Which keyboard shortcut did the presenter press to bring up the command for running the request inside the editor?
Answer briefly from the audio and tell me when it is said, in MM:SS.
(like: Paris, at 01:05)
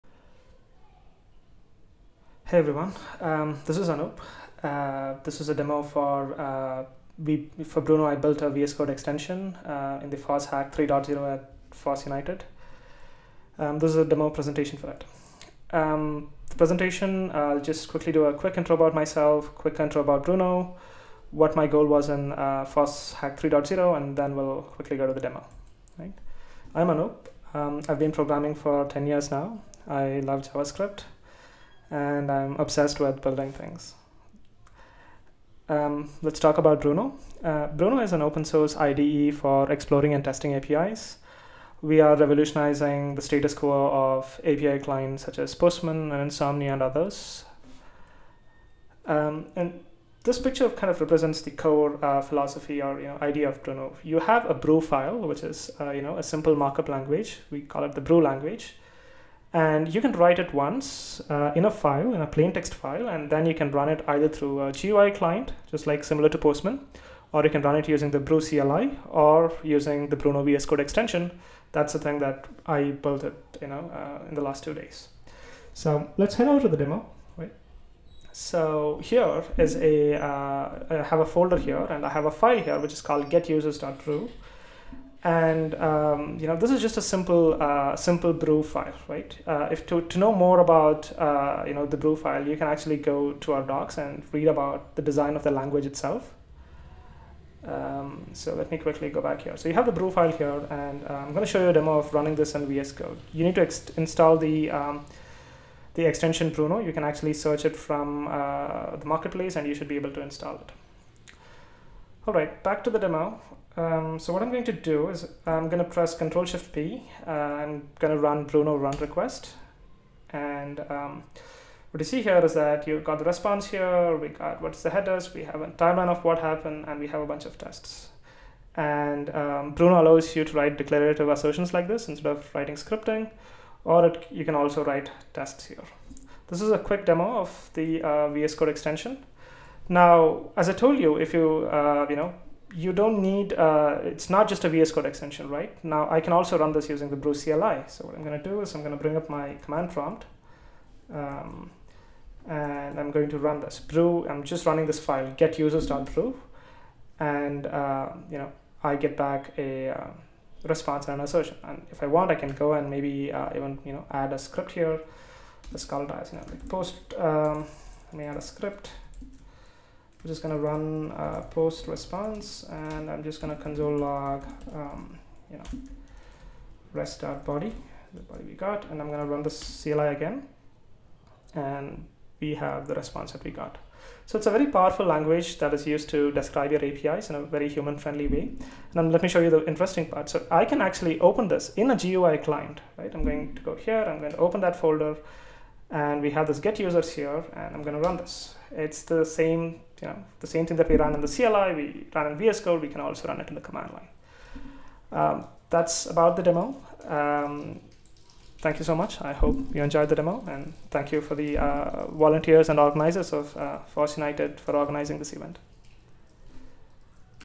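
Control Shift P, at 01:56.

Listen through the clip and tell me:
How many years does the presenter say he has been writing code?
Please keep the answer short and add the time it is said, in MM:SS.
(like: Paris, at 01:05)
10, at 00:28.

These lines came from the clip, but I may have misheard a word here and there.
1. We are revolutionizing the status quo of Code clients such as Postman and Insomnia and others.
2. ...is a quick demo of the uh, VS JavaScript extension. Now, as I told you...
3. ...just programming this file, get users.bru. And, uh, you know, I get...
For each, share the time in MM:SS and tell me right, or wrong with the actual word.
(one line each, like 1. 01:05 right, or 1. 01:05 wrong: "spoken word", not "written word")
1. 00:41 wrong: "API", not "Code"
2. 02:16 wrong: "Code", not "JavaScript"
3. 02:34 wrong: "running", not "programming".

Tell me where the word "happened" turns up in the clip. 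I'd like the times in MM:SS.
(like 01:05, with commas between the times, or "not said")
02:06.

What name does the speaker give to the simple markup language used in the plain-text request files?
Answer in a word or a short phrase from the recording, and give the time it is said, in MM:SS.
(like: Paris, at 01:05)
bru language, at 00:57.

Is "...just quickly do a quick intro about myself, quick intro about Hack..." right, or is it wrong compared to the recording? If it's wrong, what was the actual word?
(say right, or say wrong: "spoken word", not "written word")
wrong: "Bruno", not "Hack".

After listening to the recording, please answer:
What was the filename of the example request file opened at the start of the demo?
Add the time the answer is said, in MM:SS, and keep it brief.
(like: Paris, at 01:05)
getusers.bru, at 01:23.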